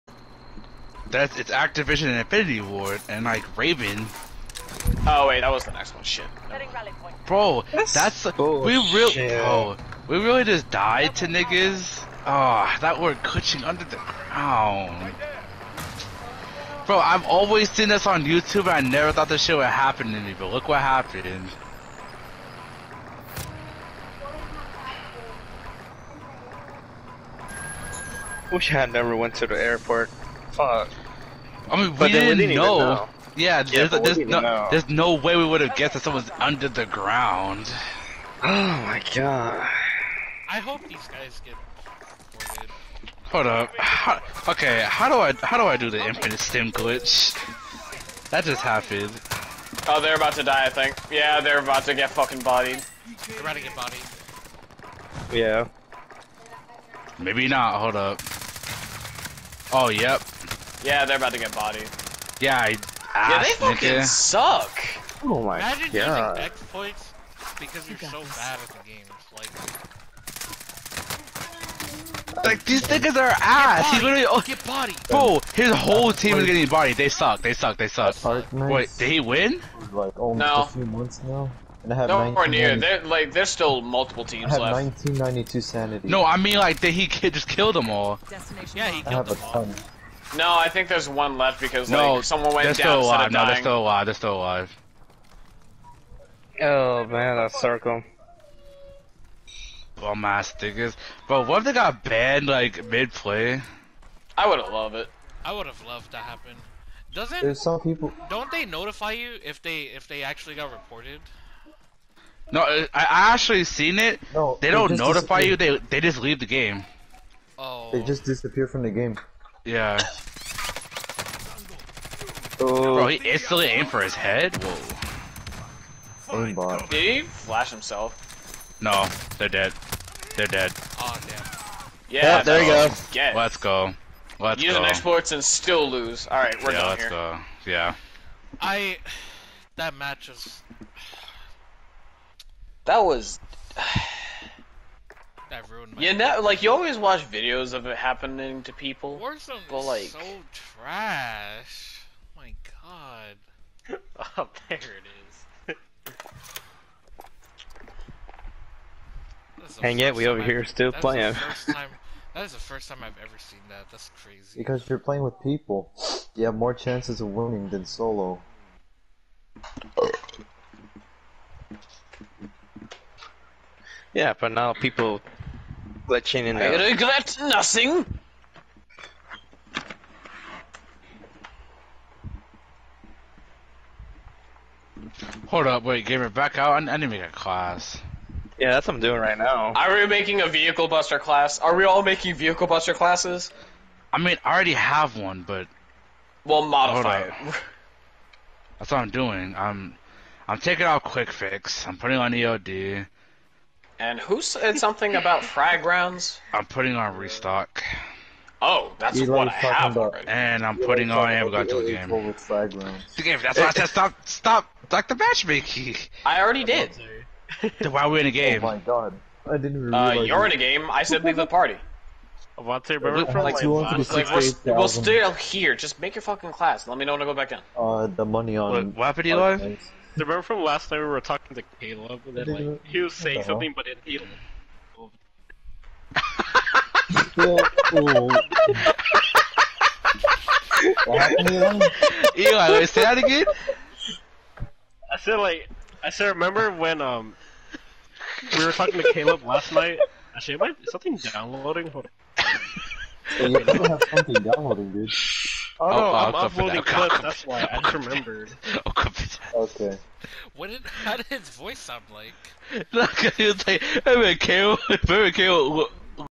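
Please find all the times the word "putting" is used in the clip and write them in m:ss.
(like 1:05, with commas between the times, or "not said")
3:21, 3:26, 3:30.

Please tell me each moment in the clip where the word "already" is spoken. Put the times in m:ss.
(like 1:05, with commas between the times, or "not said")
3:14, 3:30, 3:36.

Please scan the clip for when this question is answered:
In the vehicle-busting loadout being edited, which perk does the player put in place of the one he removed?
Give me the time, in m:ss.
3:22.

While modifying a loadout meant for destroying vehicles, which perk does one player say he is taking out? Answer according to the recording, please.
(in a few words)
Quick Fix.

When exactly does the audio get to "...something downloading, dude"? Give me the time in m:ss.
4:14.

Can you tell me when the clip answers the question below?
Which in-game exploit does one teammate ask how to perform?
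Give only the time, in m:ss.
0:46.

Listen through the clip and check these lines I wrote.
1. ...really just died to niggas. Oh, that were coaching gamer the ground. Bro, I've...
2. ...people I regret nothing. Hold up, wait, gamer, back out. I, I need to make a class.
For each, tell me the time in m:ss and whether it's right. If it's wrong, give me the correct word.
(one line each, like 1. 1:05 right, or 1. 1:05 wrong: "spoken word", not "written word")
1. 0:10 wrong: "under", not "gamer"
2. 2:54 right.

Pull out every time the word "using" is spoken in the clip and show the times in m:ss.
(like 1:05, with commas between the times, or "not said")
1:06.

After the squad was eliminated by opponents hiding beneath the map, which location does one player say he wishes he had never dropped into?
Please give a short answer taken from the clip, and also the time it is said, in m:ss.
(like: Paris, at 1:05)
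the airport, at 0:29.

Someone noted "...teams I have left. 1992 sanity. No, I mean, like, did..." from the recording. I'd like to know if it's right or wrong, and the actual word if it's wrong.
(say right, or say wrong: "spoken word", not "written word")
right.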